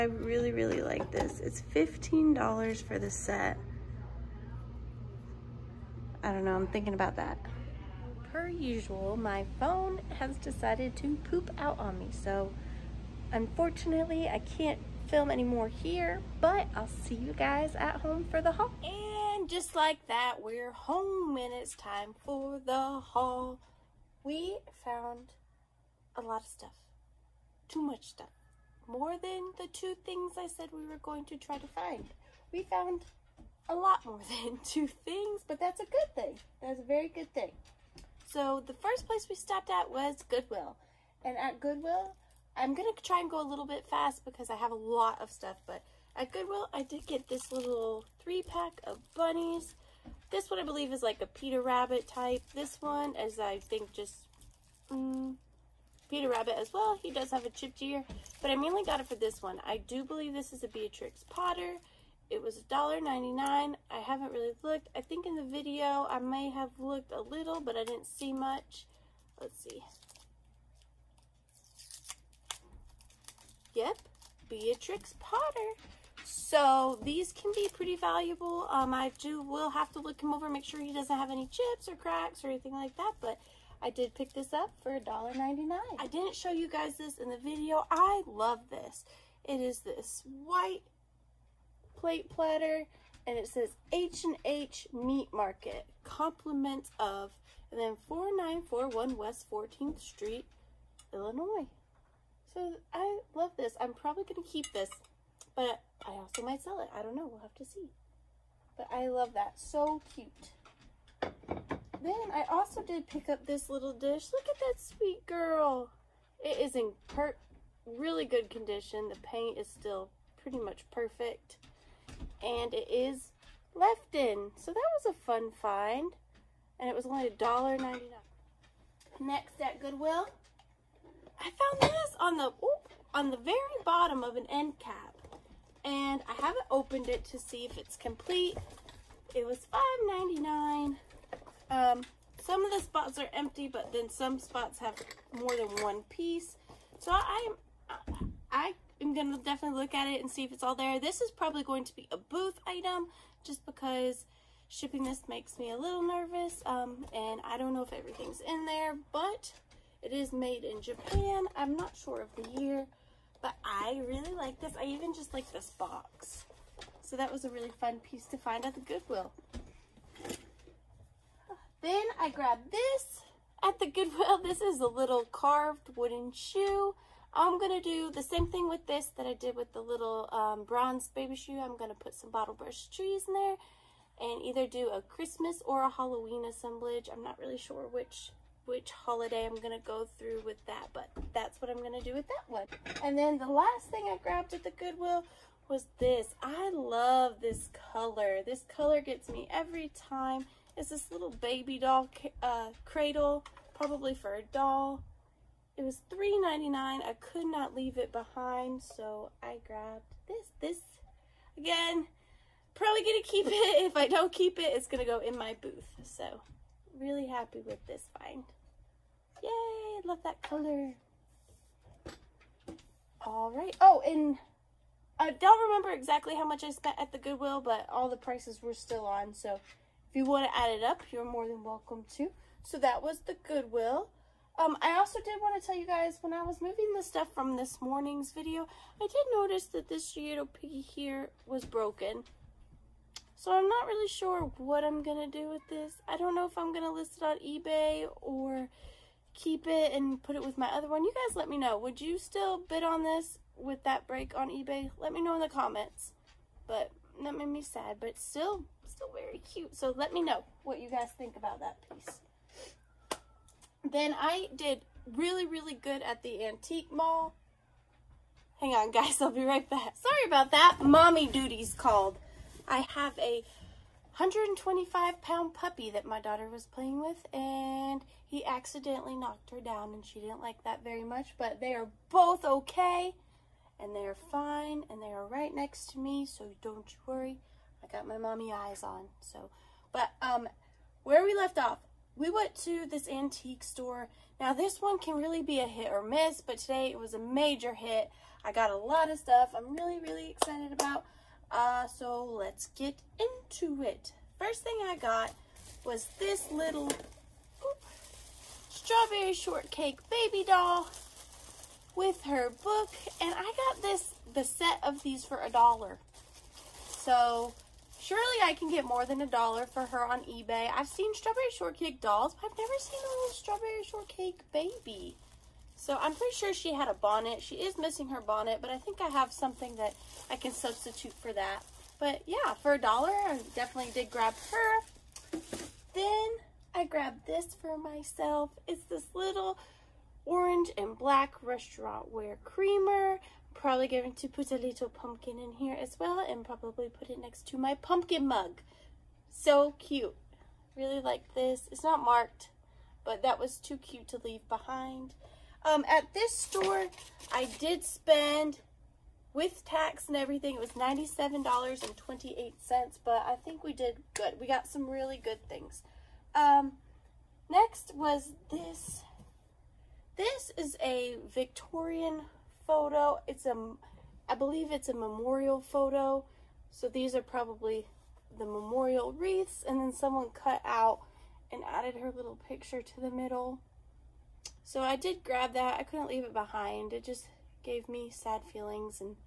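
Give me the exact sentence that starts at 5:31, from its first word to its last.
But yeah, for a dollar, I definitely did grab her.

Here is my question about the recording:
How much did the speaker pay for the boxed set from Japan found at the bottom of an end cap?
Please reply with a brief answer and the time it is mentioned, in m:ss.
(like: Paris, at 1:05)
$5.99, at 2:19.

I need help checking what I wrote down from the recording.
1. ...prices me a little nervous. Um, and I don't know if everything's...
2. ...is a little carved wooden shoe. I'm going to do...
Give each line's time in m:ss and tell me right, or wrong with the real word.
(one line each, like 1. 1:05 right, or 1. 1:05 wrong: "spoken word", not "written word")
1. 2:35 wrong: "makes", not "prices"
2. 2:54 right.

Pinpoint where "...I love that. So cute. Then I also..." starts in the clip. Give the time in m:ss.
1:48.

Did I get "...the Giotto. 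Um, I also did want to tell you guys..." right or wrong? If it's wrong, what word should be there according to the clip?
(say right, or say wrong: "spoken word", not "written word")
wrong: "Goodwill", not "Giotto".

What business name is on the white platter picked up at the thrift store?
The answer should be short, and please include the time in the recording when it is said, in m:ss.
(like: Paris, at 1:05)
H&H Meat Market, at 1:33.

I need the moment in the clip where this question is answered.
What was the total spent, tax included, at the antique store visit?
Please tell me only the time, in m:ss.
6:00.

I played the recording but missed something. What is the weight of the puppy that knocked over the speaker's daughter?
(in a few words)
125 pounds.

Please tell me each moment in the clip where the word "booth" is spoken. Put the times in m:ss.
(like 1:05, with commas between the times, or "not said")
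2:32, 3:35.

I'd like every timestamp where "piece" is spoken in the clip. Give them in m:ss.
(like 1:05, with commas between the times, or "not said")
2:26, 2:48, 4:21.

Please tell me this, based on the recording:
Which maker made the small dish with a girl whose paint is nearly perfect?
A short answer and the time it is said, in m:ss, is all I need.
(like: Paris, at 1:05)
Lefton, at 2:03.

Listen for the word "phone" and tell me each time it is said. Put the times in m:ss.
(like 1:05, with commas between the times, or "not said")
0:09.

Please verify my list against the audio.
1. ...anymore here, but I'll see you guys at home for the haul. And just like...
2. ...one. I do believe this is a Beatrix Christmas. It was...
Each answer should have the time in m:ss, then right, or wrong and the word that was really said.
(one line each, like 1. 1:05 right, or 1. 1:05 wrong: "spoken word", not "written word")
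1. 0:15 right
2. 0:59 wrong: "Potter", not "Christmas".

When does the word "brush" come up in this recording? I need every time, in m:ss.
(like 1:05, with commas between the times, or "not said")
3:02.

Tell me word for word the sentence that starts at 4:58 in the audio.
I got a lot of stuff I'm really, really excited about.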